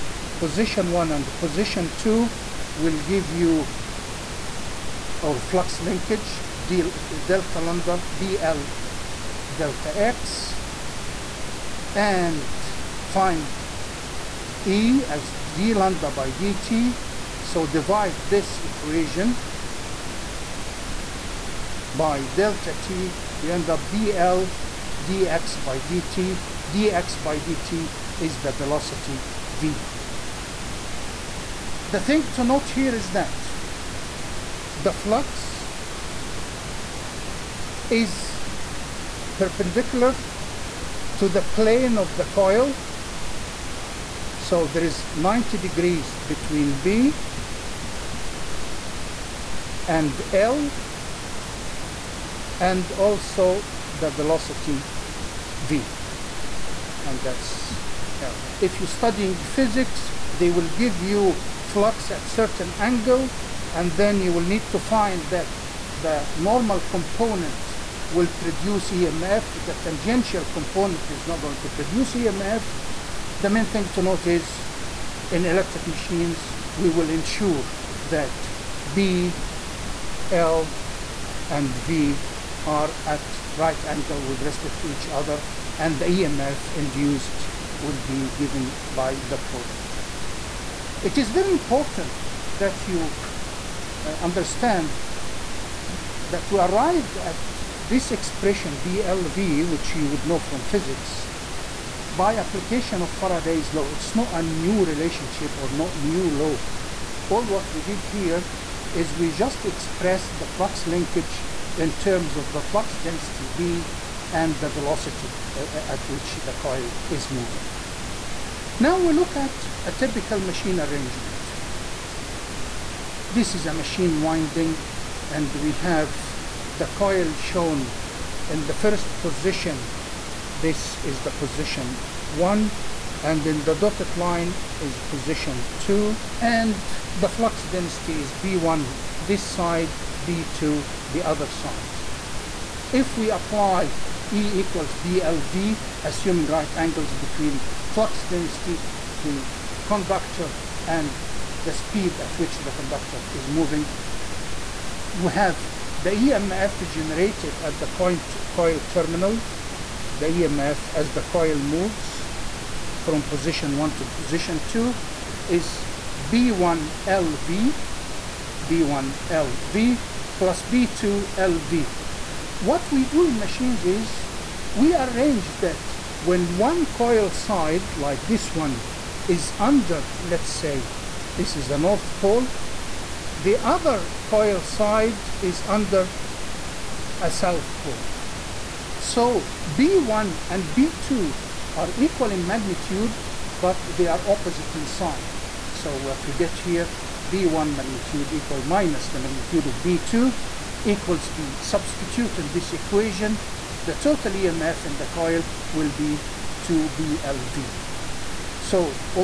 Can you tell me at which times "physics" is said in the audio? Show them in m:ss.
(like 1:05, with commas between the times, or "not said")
0:59, 1:40.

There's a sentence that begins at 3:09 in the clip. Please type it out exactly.
So B1 and B2 are equal in magnitude, but they are opposite in sign.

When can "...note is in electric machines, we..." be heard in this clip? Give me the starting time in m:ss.
1:14.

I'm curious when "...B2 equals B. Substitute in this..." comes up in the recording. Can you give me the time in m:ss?
3:19.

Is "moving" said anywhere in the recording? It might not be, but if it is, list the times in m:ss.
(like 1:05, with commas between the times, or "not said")
1:57, 2:33.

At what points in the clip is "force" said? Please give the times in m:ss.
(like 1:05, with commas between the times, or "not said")
not said.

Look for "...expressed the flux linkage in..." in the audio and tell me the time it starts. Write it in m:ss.
1:49.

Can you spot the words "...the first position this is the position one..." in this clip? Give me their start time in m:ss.
2:08.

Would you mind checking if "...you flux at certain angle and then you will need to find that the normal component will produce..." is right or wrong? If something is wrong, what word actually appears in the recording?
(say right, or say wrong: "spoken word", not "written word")
right.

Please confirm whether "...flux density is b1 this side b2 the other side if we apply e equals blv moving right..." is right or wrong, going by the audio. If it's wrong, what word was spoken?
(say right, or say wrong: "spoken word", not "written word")
wrong: "assuming", not "moving".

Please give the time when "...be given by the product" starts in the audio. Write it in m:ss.
1:27.